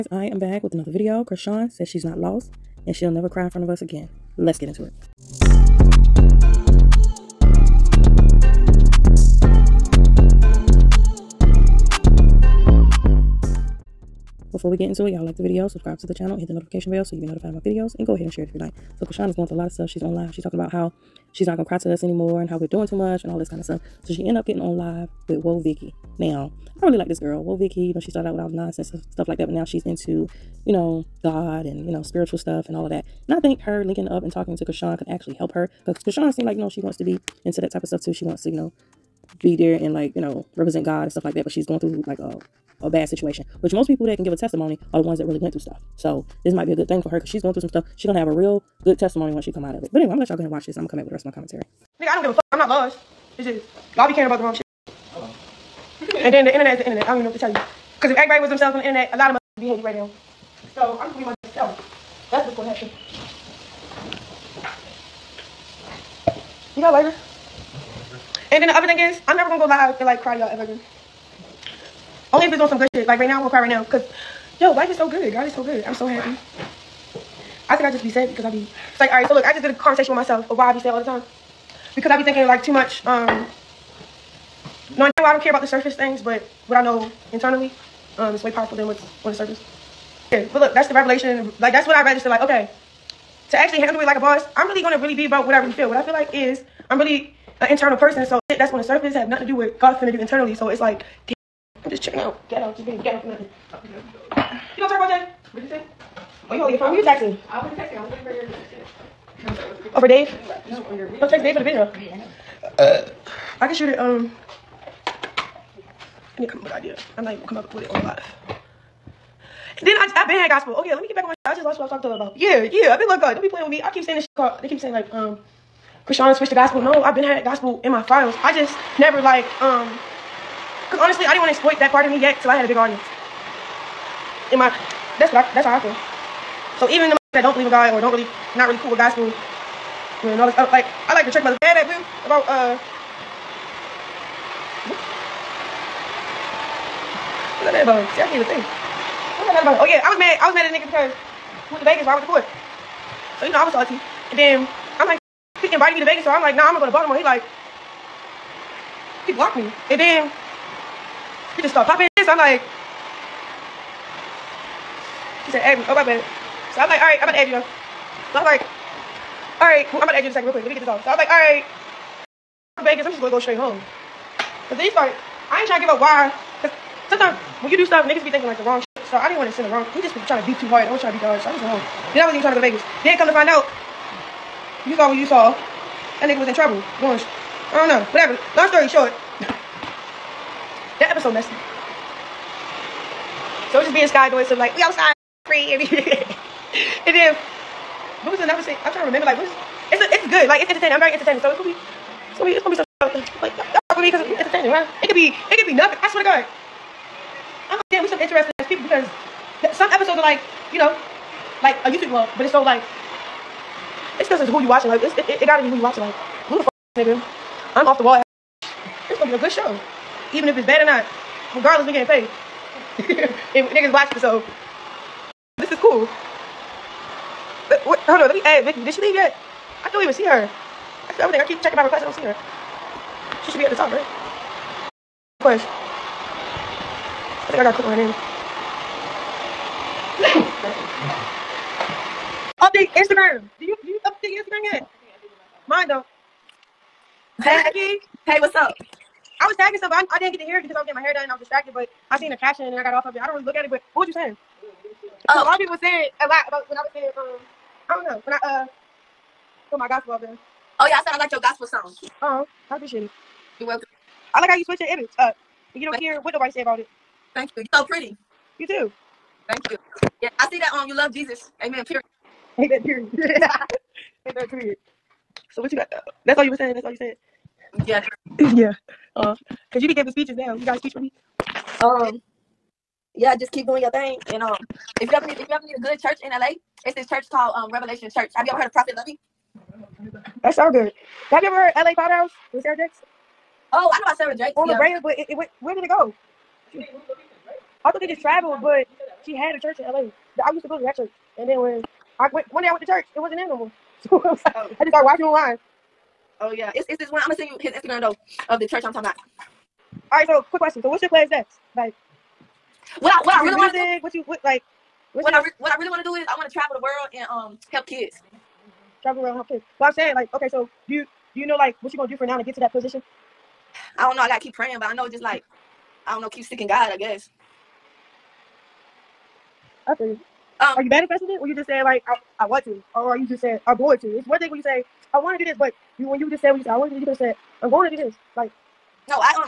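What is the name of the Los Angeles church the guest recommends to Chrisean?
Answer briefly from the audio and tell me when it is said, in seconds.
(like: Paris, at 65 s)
Revelation Church, at 287 s.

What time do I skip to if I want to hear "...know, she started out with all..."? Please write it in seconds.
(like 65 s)
27 s.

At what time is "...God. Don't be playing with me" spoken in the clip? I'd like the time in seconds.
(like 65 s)
123 s.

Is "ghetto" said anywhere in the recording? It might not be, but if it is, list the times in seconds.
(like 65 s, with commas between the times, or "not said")
102 s.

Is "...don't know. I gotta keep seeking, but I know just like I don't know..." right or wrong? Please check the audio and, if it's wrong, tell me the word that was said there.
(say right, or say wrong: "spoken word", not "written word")
wrong: "praying", not "seeking".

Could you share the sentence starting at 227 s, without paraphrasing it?
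But, uh, what, hold on, let me add Vicky.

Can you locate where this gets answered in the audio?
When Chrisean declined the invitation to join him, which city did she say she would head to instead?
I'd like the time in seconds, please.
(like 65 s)
156 s.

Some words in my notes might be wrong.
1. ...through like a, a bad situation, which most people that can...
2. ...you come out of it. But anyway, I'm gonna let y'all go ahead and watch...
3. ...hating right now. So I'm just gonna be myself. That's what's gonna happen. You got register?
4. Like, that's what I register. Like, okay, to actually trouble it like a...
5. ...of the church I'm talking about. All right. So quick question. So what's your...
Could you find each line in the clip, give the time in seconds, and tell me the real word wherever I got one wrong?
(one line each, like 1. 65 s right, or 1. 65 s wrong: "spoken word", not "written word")
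1. 41 s right
2. 49 s right
3. 59 s wrong: "lighter", not "register"
4. 91 s wrong: "handle", not "trouble"
5. 308 s right.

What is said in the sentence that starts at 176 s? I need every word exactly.
Because sometimes when you do stuff, niggas be thinking like the wrong shit.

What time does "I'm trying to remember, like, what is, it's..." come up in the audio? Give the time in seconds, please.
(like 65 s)
198 s.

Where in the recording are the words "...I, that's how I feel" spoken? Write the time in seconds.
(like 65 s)
135 s.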